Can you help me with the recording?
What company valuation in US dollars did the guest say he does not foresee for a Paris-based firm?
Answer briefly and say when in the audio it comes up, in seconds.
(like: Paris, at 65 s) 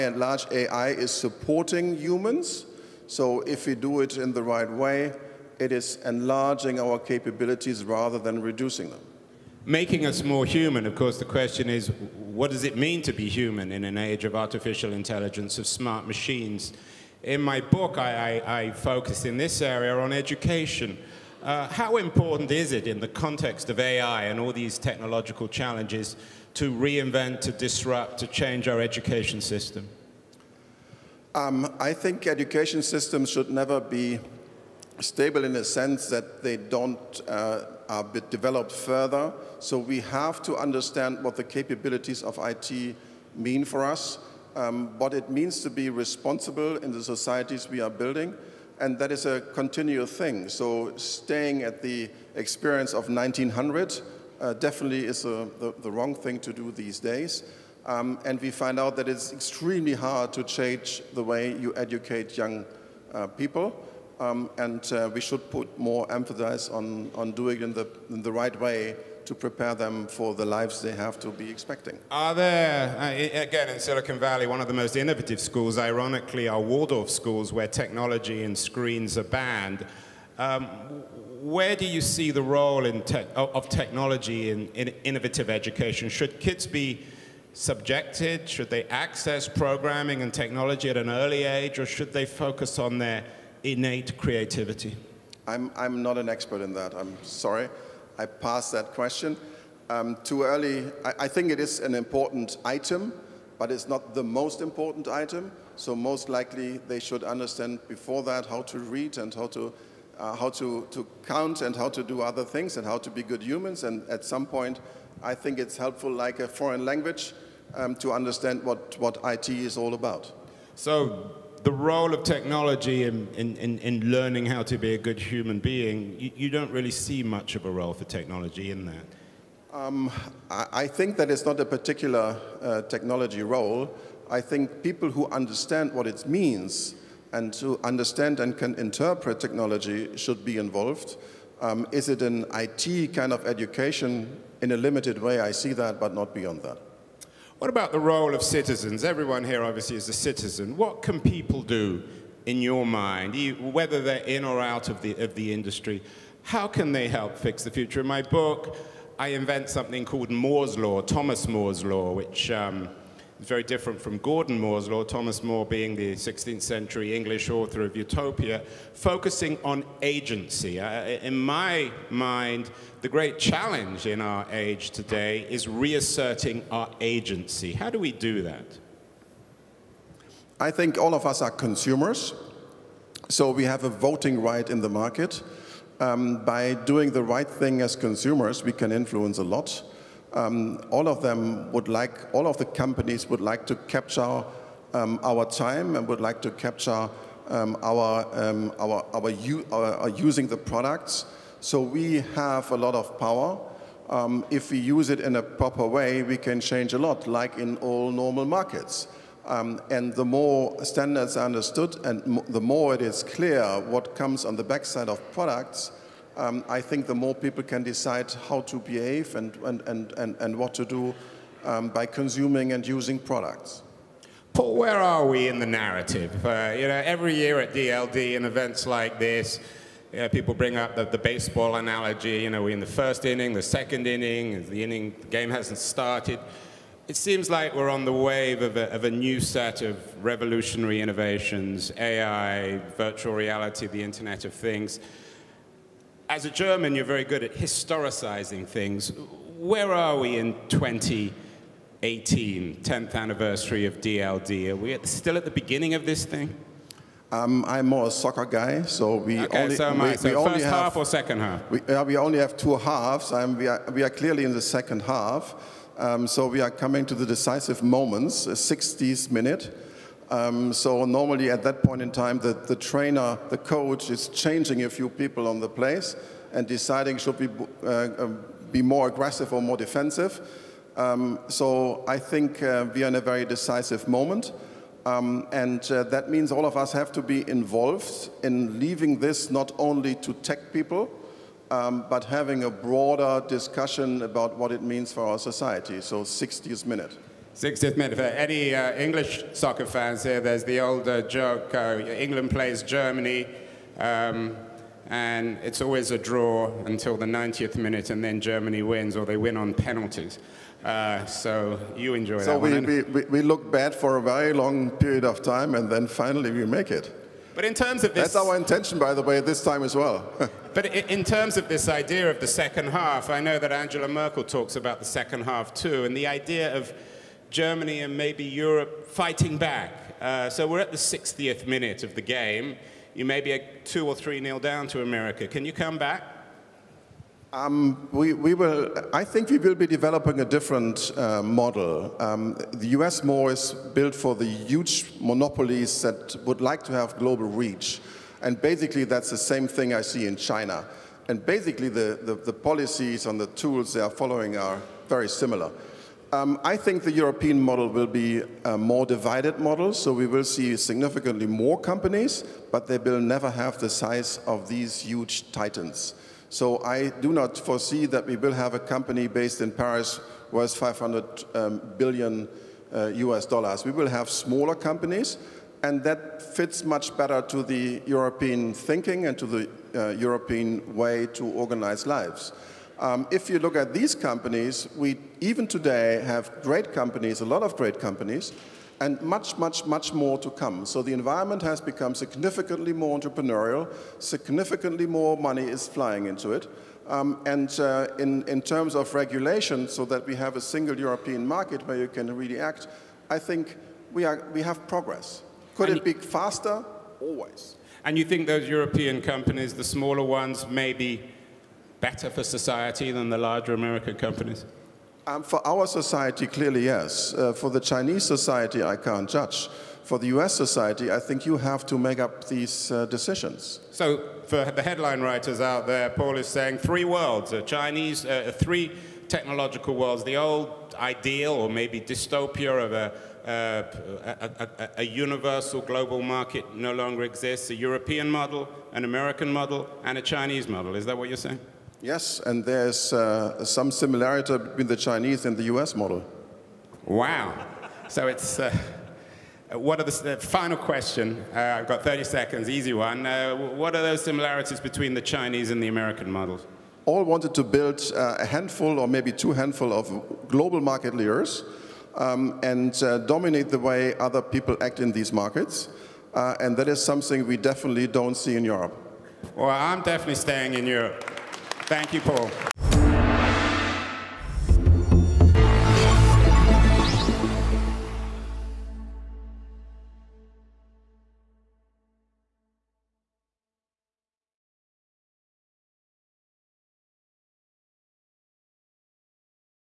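500 billion, at 370 s.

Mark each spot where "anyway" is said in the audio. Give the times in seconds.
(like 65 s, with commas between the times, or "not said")
not said.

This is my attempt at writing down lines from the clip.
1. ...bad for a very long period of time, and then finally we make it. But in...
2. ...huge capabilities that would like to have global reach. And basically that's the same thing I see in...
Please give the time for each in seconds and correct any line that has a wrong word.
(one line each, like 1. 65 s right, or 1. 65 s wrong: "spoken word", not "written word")
1. 313 s right
2. 344 s wrong: "monopolies", not "capabilities".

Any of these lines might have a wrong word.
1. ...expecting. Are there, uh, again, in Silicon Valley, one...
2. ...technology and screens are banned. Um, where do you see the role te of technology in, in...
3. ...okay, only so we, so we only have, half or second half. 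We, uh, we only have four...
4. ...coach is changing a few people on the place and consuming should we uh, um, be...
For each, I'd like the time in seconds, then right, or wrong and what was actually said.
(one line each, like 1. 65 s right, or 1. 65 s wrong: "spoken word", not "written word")
1. 71 s right
2. 77 s right
3. 259 s wrong: "two", not "four"
4. 273 s wrong: "deciding", not "consuming".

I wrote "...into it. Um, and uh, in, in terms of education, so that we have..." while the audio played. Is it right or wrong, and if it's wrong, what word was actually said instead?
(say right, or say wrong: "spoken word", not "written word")
wrong: "regulation", not "education".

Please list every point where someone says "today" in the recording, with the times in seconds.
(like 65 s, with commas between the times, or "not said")
174 s, 385 s.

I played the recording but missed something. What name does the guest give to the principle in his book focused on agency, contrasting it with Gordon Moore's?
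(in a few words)
Thomas More's Law.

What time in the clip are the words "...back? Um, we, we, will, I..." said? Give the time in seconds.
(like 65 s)
335 s.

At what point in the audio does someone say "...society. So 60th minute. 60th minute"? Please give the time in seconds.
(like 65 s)
295 s.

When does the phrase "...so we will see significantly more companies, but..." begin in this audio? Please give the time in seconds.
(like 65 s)
359 s.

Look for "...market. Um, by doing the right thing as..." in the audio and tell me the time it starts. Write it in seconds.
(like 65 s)
184 s.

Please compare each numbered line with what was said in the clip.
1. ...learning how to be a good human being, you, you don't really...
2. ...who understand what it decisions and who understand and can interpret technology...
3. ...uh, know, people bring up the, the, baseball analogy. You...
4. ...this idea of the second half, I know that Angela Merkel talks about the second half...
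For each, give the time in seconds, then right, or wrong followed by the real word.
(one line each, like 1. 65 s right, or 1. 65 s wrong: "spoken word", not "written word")
1. 124 s right
2. 135 s wrong: "means", not "decisions"
3. 230 s right
4. 321 s right.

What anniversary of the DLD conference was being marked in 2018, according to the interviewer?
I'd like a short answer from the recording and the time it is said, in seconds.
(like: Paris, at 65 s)
10th anniversary, at 252 s.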